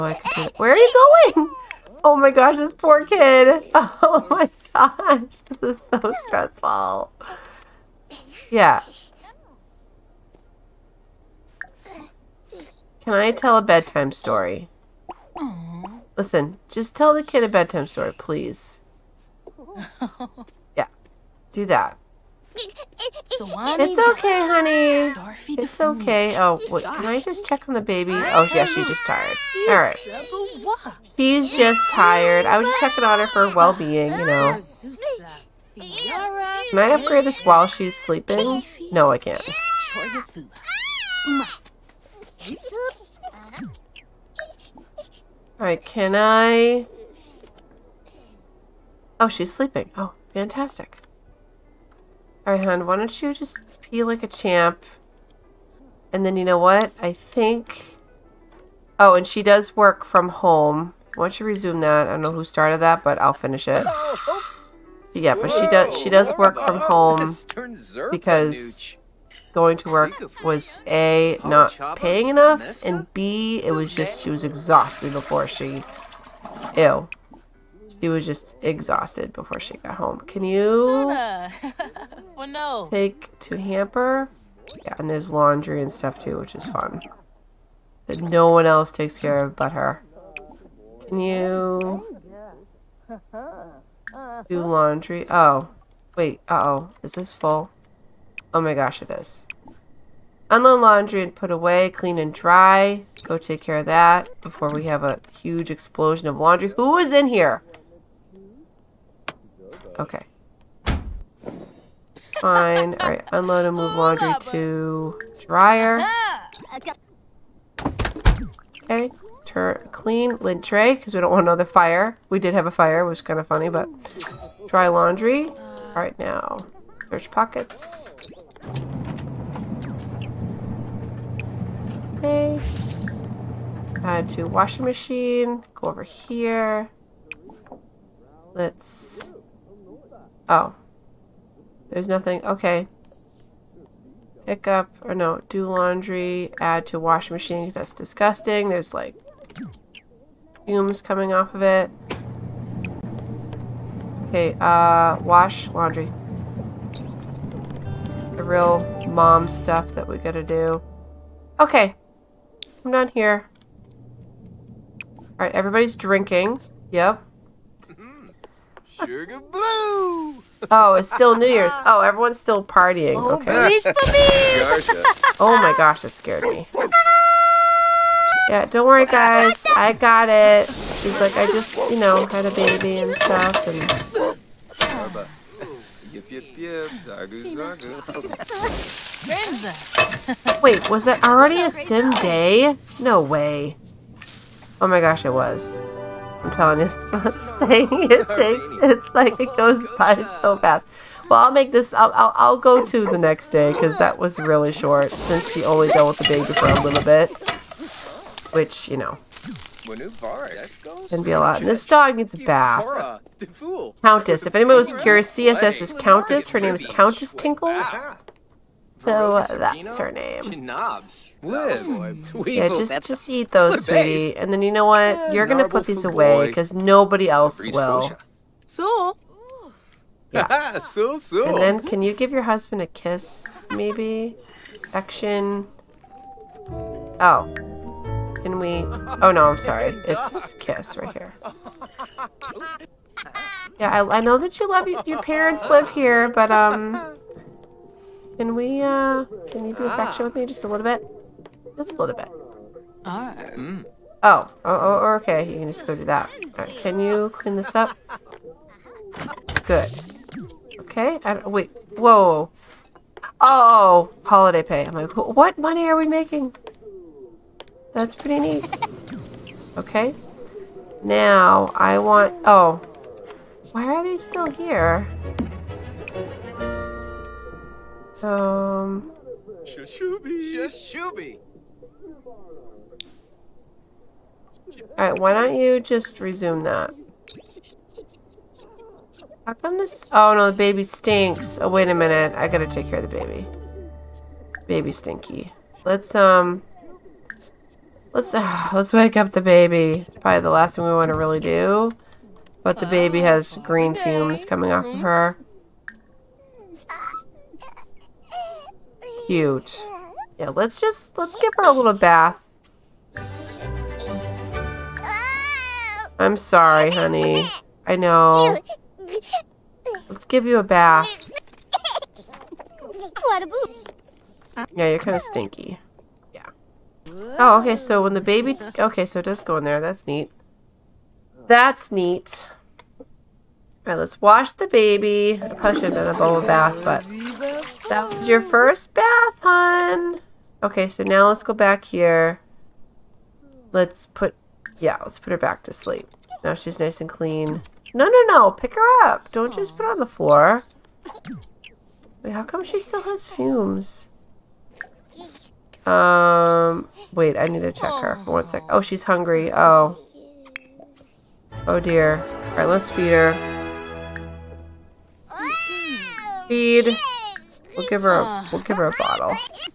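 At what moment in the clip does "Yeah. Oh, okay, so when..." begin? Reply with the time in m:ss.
5:26.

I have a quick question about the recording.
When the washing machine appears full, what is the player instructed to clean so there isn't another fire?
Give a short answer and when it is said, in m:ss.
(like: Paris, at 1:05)
lint tray, at 2:00.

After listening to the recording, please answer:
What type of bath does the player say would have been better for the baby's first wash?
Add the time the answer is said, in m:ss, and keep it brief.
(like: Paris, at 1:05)
bubble bath, at 5:36.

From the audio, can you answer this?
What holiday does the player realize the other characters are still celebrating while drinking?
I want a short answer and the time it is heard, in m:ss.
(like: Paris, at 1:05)
New Year's, at 2:51.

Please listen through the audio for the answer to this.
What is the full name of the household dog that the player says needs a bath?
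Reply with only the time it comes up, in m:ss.
3:36.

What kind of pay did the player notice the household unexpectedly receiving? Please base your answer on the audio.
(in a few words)
holiday pay.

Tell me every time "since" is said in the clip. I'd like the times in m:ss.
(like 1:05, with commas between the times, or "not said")
3:25.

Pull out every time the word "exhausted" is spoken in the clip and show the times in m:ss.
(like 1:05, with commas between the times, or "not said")
1:14, 1:18.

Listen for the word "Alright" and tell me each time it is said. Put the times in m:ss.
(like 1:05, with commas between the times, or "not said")
0:45, 0:52, 1:52, 2:05, 2:45, 4:44, 5:33.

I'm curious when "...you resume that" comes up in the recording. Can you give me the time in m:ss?
1:01.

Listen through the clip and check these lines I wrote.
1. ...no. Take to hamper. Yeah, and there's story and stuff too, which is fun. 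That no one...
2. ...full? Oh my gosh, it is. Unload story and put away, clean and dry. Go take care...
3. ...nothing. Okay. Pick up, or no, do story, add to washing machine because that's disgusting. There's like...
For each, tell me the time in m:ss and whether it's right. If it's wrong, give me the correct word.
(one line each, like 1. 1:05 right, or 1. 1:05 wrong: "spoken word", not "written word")
1. 1:22 wrong: "laundry", not "story"
2. 1:37 wrong: "laundry", not "story"
3. 2:22 wrong: "laundry", not "story".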